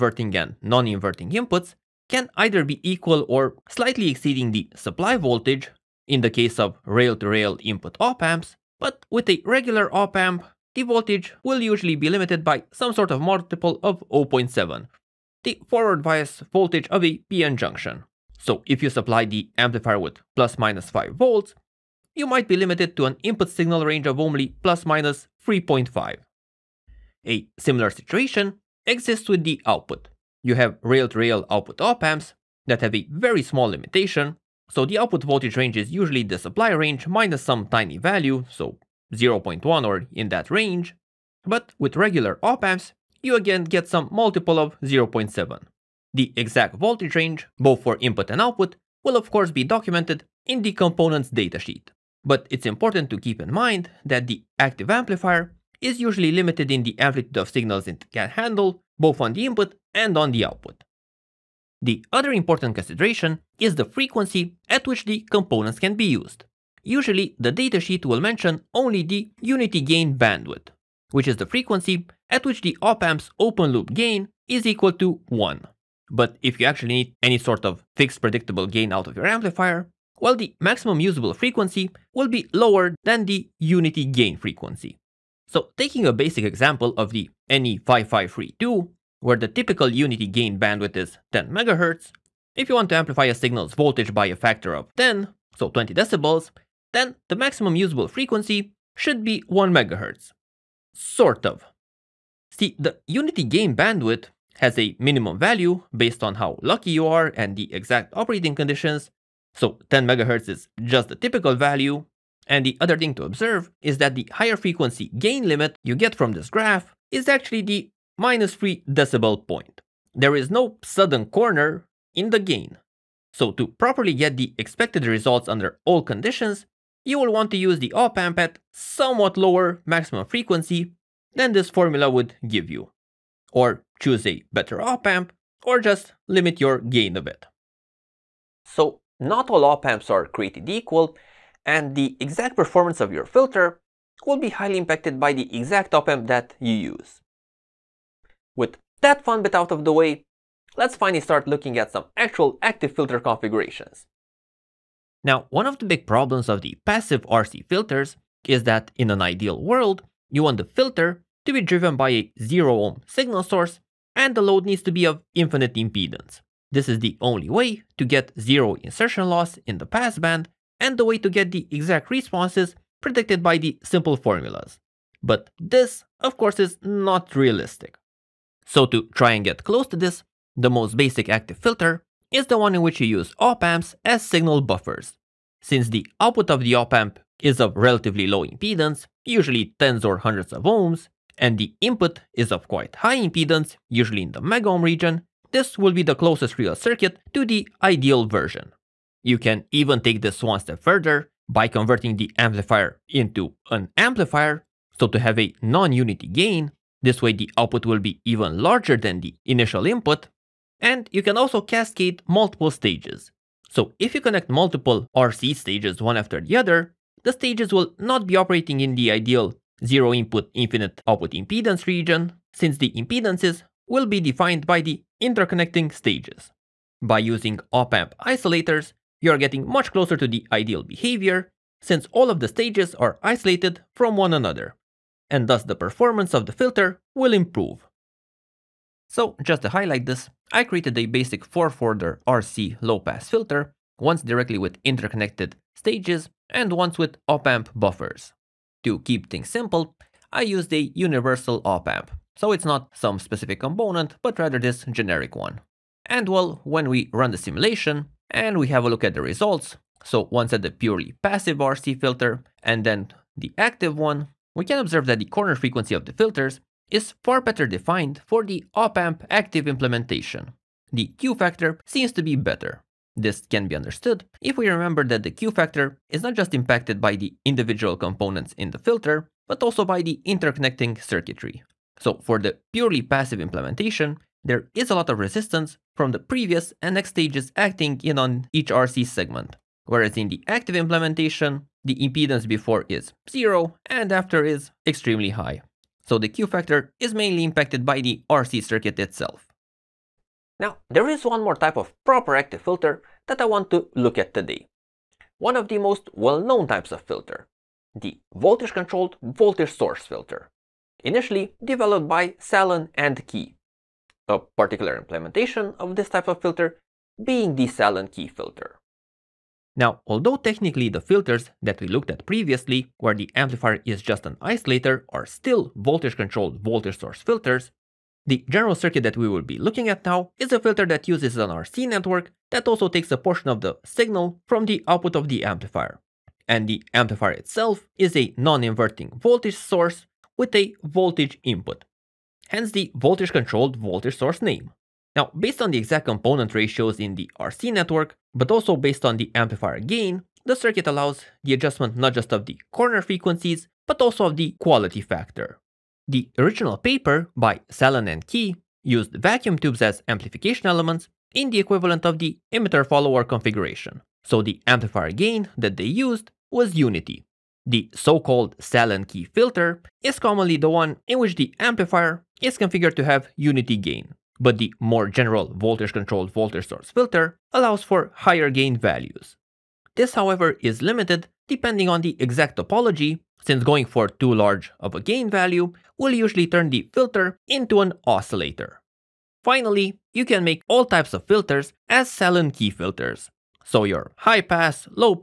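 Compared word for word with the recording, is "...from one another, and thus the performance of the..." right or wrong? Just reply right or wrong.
right.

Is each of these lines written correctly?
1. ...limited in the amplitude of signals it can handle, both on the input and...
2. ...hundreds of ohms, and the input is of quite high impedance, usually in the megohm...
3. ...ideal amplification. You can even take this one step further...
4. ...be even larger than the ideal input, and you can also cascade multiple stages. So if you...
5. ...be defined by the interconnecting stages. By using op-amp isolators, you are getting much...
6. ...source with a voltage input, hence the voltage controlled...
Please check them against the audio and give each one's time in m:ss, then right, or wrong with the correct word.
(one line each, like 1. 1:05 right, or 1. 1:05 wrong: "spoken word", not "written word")
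1. 0:56 right
2. 3:10 right
3. 3:17 wrong: "version", not "amplification"
4. 3:27 wrong: "initial", not "ideal"
5. 3:44 right
6. 5:39 right.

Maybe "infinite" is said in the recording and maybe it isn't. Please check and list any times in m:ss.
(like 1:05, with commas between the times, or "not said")
2:45, 3:40.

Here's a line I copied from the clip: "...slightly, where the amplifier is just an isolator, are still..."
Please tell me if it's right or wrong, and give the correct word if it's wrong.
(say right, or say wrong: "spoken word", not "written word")
wrong: "previously", not "slightly".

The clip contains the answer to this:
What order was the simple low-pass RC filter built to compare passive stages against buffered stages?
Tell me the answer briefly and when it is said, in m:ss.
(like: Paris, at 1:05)
4th order, at 4:01.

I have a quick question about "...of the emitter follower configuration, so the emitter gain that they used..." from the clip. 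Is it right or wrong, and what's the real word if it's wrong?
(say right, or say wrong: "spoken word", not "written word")
wrong: "amplifier", not "emitter".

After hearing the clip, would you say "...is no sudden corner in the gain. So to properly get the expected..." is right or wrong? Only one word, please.
right.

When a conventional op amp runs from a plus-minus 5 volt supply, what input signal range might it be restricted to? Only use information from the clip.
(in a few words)
plus minus 3.5.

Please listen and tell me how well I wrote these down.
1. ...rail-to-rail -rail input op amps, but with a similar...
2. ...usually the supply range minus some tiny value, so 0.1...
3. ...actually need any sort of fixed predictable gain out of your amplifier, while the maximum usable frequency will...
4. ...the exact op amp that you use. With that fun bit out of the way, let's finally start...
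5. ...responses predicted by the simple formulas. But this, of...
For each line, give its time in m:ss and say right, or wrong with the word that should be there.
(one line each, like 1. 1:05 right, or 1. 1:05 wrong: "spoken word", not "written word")
1. 0:06 wrong: "regular", not "similar"
2. 0:36 right
3. 1:16 right
4. 2:25 right
5. 2:52 right.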